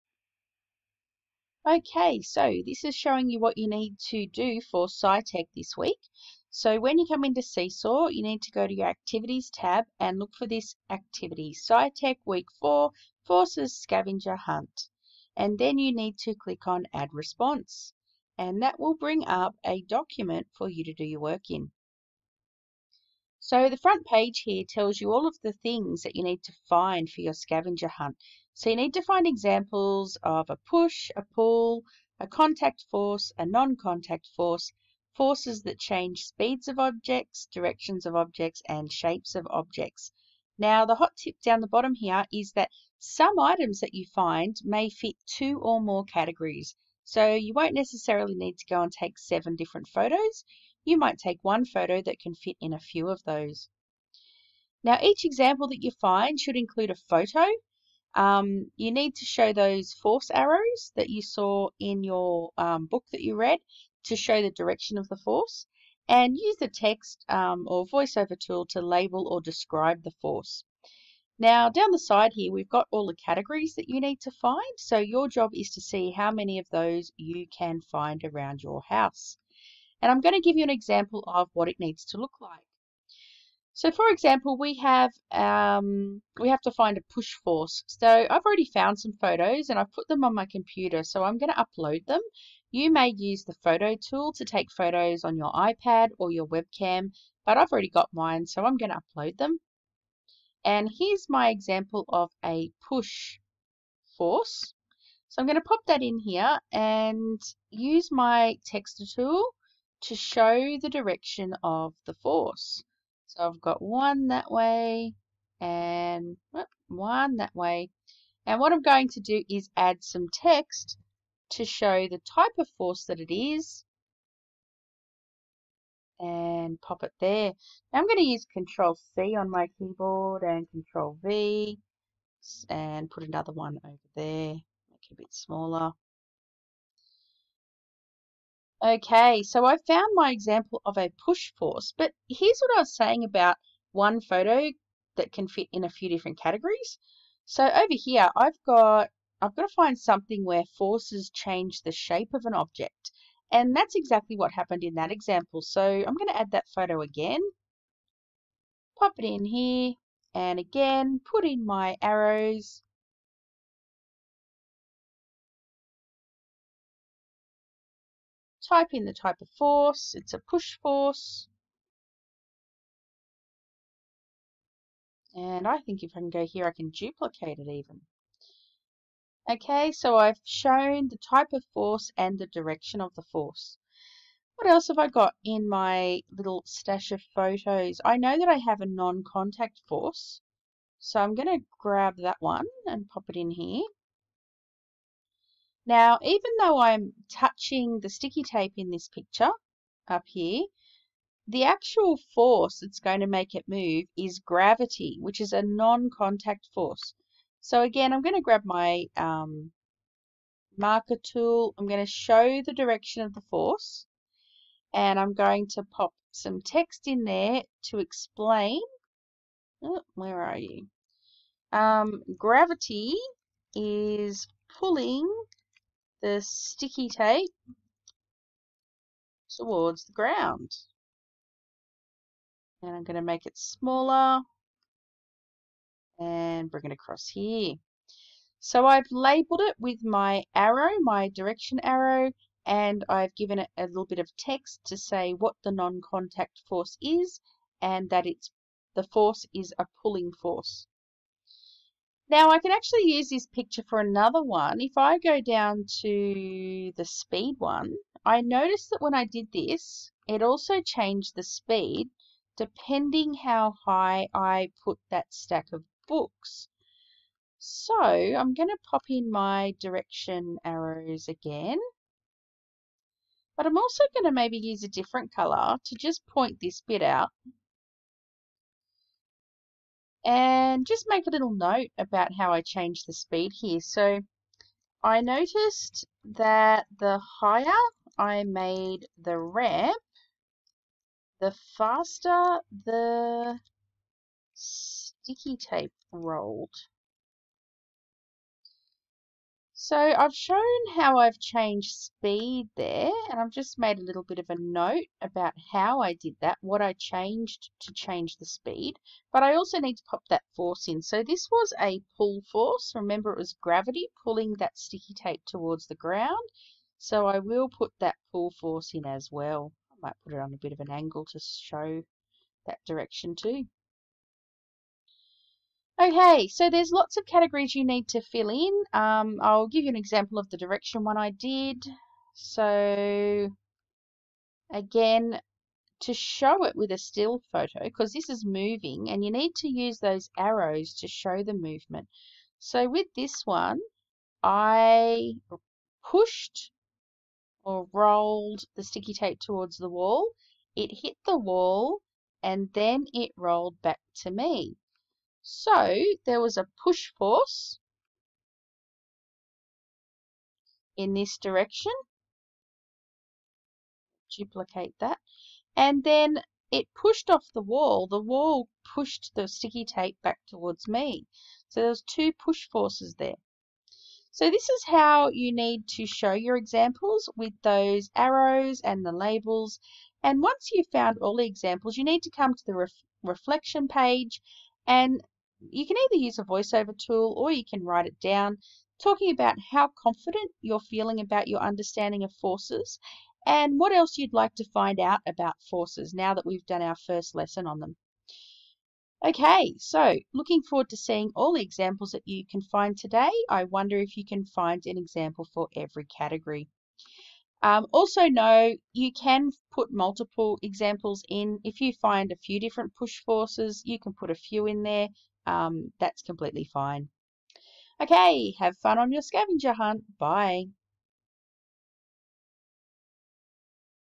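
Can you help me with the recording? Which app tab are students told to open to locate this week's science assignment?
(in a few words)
Activities.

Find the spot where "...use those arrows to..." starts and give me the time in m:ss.
5:39.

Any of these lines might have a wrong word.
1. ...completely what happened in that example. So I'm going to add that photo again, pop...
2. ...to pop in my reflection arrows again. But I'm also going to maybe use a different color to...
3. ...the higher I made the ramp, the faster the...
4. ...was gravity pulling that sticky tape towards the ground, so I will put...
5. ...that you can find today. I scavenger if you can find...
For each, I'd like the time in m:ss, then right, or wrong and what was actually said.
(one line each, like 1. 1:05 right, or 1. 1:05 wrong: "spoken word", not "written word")
1. 2:33 wrong: "exactly", not "completely"
2. 4:28 wrong: "direction", not "reflection"
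3. 4:46 right
4. 5:13 right
5. 6:42 wrong: "wonder", not "scavenger".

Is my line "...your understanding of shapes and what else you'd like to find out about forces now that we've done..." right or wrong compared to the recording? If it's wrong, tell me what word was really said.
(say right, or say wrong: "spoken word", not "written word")
wrong: "forces", not "shapes".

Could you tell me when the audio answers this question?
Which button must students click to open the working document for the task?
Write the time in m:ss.
0:16.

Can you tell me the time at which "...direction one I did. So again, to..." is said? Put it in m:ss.
5:30.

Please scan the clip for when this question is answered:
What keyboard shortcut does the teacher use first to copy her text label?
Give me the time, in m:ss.
2:08.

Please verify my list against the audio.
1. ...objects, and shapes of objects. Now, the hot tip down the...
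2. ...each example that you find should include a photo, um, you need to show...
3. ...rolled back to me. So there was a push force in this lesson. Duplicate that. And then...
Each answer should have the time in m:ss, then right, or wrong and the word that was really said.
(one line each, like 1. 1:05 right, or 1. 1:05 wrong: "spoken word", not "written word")
1. 0:38 right
2. 0:55 right
3. 5:53 wrong: "direction", not "lesson".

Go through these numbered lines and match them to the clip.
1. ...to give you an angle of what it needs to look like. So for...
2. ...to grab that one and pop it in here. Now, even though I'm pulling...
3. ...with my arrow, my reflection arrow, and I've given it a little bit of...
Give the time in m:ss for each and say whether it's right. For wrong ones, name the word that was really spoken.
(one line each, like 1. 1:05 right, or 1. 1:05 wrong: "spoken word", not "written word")
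1. 1:20 wrong: "example", not "angle"
2. 3:11 wrong: "touching", not "pulling"
3. 3:59 wrong: "direction", not "reflection".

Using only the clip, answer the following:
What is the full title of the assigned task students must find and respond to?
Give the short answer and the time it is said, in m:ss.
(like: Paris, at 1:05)
SciTech Week 4, Forces Scavenger Hunt, at 0:11.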